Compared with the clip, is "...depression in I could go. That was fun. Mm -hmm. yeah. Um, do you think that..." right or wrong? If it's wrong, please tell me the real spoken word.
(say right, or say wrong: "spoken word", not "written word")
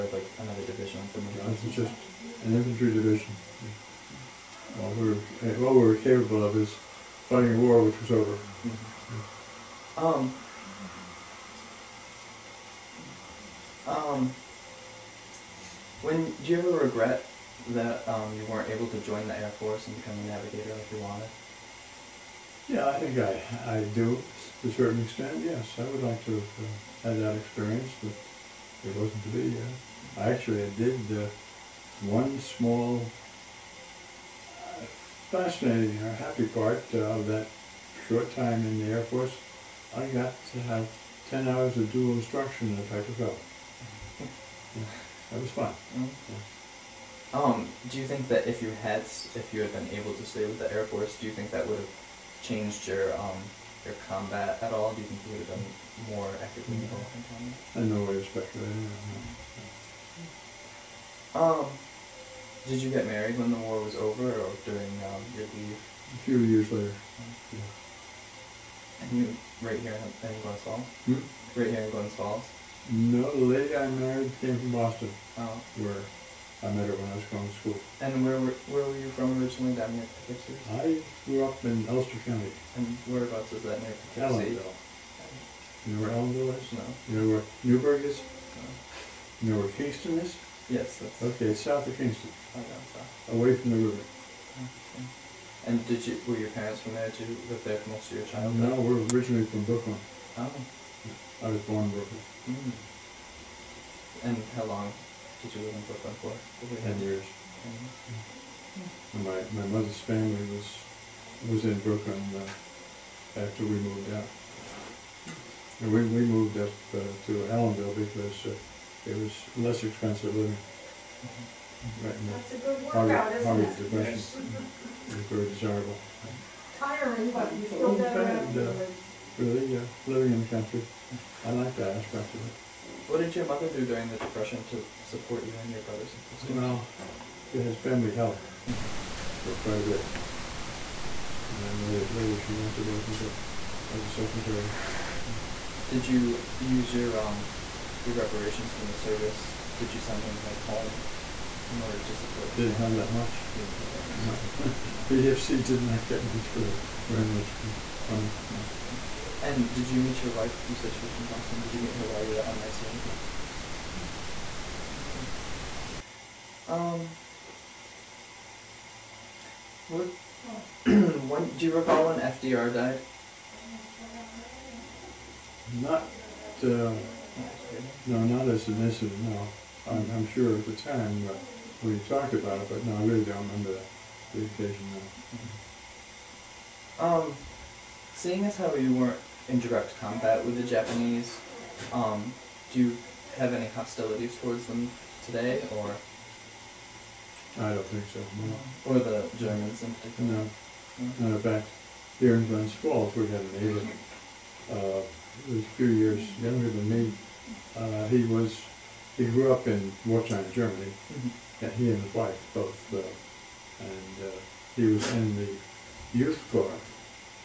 wrong: "instruction", not "depression".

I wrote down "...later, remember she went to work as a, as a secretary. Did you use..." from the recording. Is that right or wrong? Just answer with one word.
wrong.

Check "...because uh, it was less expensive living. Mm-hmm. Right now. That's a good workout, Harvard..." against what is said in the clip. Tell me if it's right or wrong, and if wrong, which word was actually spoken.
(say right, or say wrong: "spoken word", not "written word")
right.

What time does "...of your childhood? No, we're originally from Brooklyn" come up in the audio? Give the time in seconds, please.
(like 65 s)
98 s.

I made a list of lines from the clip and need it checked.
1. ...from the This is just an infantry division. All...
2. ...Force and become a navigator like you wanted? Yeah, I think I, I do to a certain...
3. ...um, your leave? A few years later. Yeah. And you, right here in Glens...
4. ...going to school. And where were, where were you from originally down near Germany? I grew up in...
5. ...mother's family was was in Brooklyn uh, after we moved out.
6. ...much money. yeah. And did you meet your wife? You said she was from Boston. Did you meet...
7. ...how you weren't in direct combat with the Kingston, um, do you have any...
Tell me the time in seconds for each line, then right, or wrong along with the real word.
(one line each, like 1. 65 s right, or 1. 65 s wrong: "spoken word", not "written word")
1. 1 s right
2. 19 s right
3. 65 s right
4. 77 s wrong: "Poughkeepsie", not "Germany"
5. 109 s right
6. 157 s right
7. 188 s wrong: "Japanese", not "Kingston".